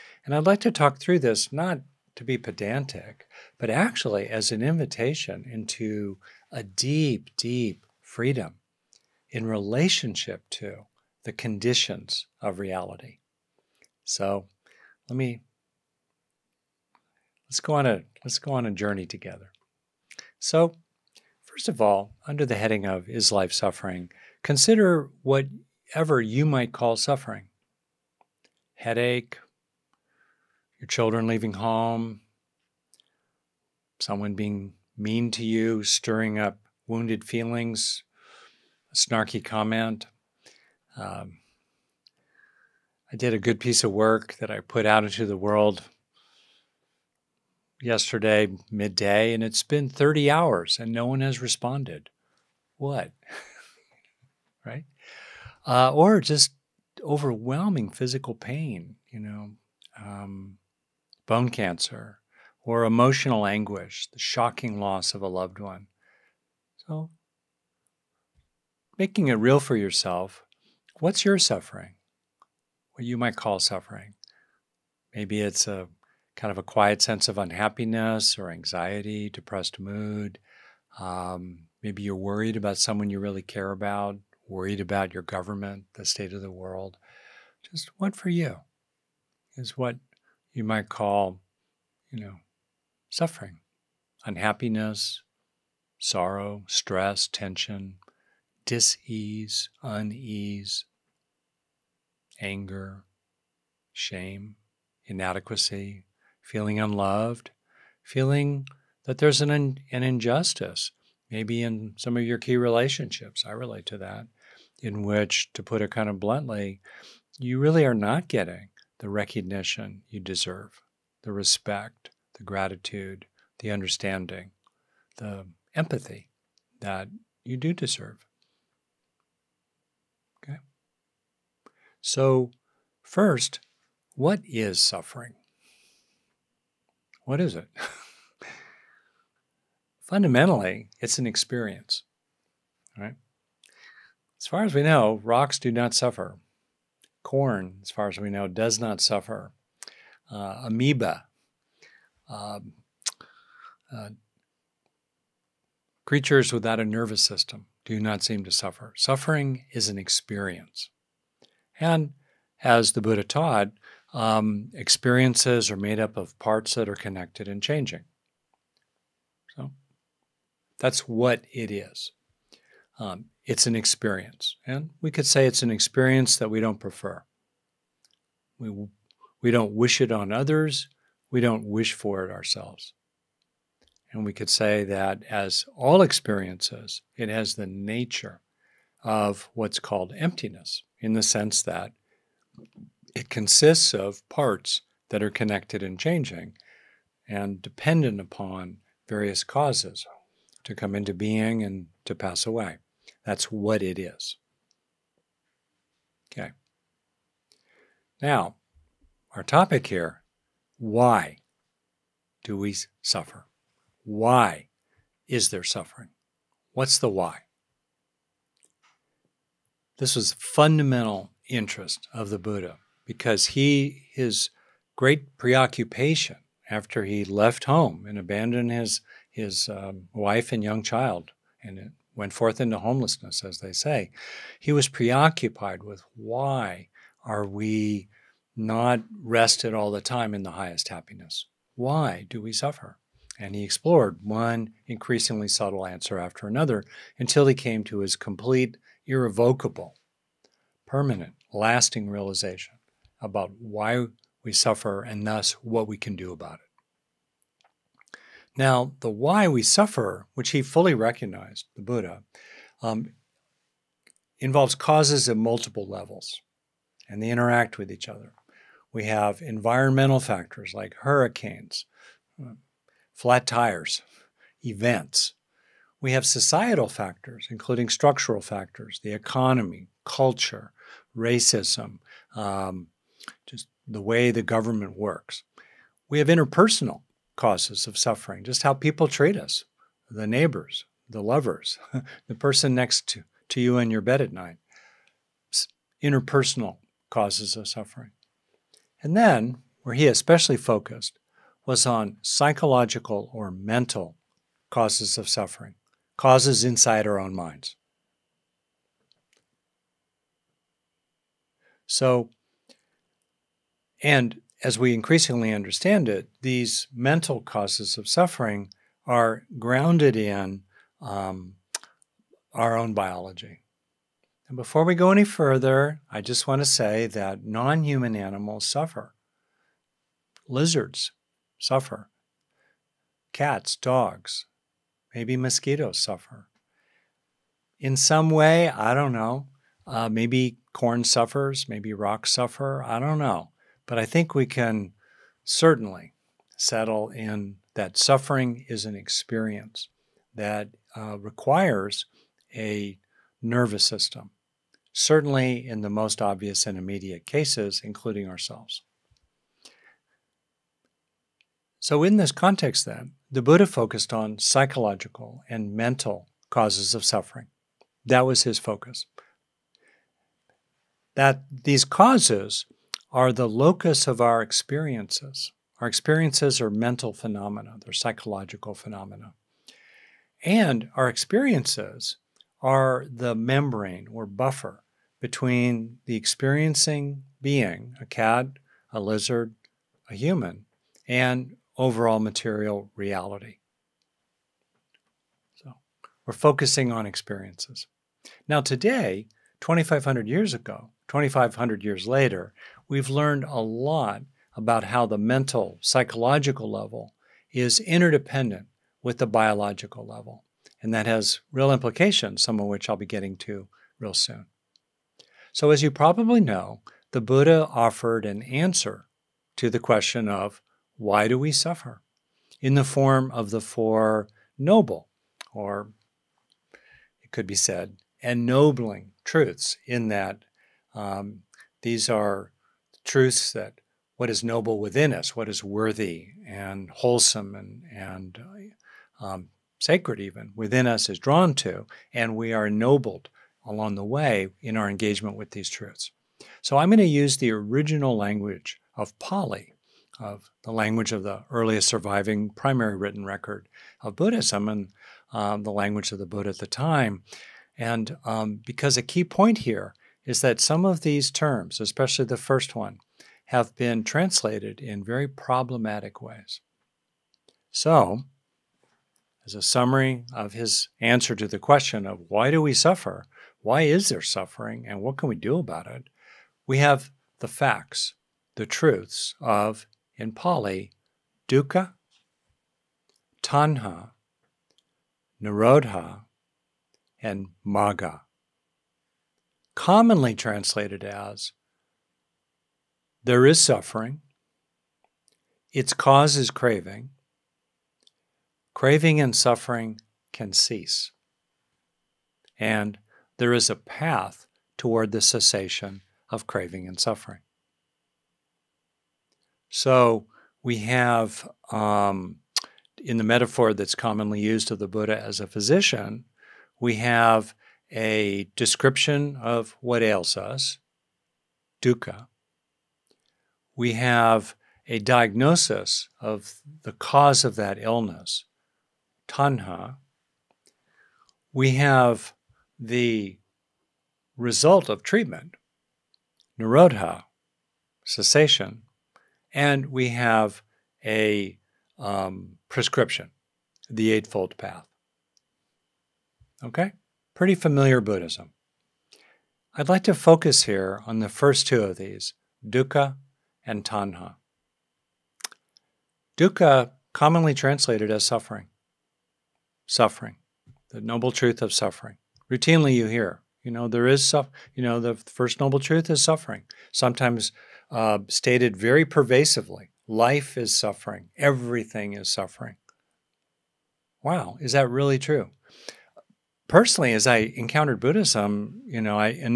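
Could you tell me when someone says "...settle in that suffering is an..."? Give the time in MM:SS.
05:46.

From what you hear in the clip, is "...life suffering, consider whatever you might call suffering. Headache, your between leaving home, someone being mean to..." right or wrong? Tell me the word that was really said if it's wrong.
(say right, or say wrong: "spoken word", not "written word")
wrong: "children", not "between".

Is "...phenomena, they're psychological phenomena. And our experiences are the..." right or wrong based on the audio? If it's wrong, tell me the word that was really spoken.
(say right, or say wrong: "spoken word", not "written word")
right.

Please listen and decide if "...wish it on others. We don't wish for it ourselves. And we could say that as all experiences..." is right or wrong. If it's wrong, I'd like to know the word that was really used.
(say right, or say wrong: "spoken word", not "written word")
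right.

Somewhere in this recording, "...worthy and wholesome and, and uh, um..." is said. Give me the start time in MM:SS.
07:15.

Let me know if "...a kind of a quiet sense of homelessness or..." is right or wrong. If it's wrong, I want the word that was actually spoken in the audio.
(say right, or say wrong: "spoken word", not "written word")
wrong: "unhappiness", not "homelessness".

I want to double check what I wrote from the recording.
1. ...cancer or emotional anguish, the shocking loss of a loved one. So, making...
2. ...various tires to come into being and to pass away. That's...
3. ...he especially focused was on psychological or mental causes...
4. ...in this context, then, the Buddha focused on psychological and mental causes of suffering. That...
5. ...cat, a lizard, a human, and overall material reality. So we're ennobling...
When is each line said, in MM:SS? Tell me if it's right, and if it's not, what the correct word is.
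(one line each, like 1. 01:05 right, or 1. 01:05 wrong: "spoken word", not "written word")
1. 01:01 right
2. 03:19 wrong: "causes", not "tires"
3. 04:59 right
4. 06:02 right
5. 06:28 wrong: "focusing", not "ennobling".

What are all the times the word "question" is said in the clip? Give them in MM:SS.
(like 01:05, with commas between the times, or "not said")
06:59, 07:51.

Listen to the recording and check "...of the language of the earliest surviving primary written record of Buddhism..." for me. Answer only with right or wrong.
right.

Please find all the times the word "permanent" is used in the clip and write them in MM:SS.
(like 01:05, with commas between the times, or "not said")
04:10.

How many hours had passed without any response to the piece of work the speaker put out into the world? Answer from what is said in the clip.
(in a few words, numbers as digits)
30.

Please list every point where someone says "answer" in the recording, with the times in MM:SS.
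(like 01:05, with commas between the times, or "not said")
04:05, 06:58, 07:51.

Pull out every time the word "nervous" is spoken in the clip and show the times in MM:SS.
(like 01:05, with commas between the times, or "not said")
02:36, 05:53.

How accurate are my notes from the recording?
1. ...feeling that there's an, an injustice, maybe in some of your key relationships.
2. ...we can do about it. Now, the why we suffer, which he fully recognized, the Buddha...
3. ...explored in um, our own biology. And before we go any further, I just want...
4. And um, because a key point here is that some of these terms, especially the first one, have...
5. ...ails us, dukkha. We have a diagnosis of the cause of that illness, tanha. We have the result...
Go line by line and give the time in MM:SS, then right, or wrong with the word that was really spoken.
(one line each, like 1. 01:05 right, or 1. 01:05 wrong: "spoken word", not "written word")
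1. 01:48 right
2. 04:15 right
3. 05:19 wrong: "grounded", not "explored"
4. 07:37 right
5. 08:40 right.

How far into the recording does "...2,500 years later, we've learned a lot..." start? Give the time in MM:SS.
06:41.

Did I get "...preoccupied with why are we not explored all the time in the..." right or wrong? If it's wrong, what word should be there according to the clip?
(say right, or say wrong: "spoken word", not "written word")
wrong: "rested", not "explored".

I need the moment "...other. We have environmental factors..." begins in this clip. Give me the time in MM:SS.
04:28.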